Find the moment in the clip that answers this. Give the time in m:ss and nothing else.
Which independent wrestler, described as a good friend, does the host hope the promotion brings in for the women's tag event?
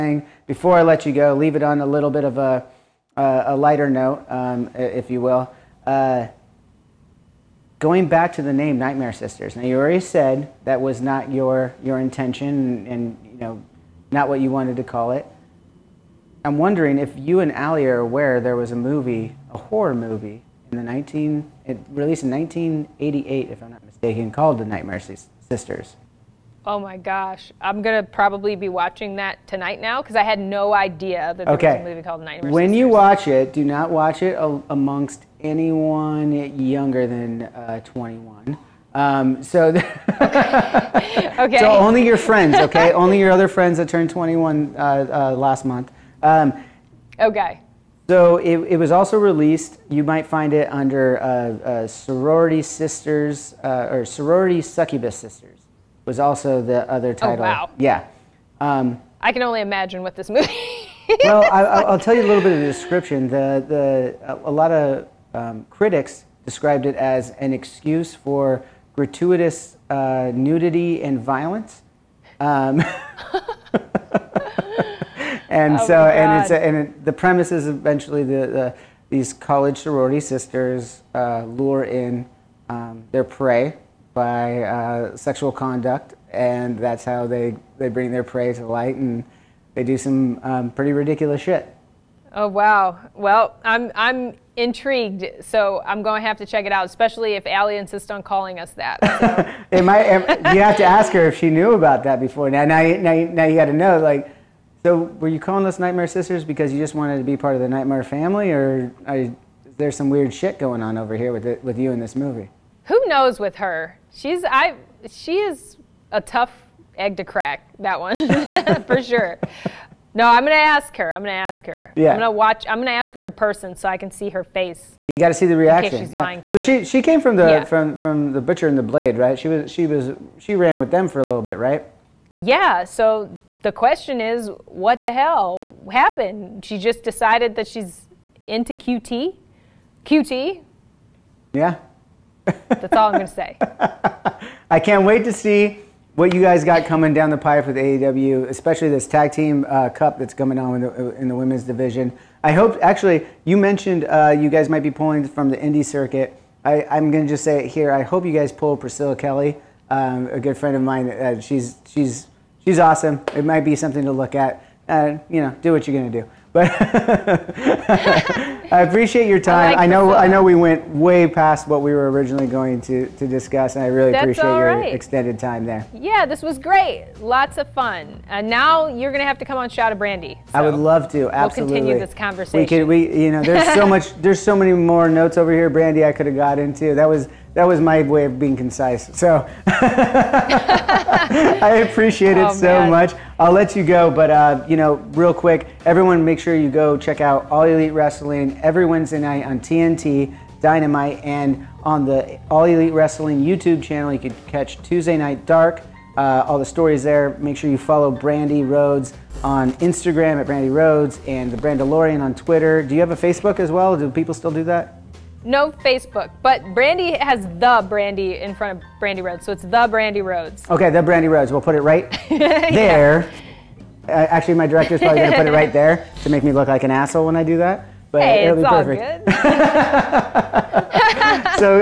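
2:38.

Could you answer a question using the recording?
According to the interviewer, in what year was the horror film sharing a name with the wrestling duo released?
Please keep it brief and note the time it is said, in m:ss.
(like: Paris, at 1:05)
1988, at 0:22.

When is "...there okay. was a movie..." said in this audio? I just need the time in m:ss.
0:31.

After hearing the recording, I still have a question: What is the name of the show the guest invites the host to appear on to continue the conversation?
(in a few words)
Shot of Brandi.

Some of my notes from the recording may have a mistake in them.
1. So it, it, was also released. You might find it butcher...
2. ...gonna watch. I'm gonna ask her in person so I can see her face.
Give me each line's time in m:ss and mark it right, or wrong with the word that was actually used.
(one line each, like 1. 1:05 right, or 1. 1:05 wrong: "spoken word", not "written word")
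1. 0:48 wrong: "under", not "butcher"
2. 2:02 right.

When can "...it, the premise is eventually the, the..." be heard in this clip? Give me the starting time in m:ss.
1:16.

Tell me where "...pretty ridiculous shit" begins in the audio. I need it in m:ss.
1:30.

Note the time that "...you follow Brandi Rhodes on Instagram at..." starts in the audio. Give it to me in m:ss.
3:27.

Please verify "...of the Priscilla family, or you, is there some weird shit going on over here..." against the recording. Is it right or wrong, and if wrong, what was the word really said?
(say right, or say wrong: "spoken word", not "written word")
wrong: "Nightmare", not "Priscilla".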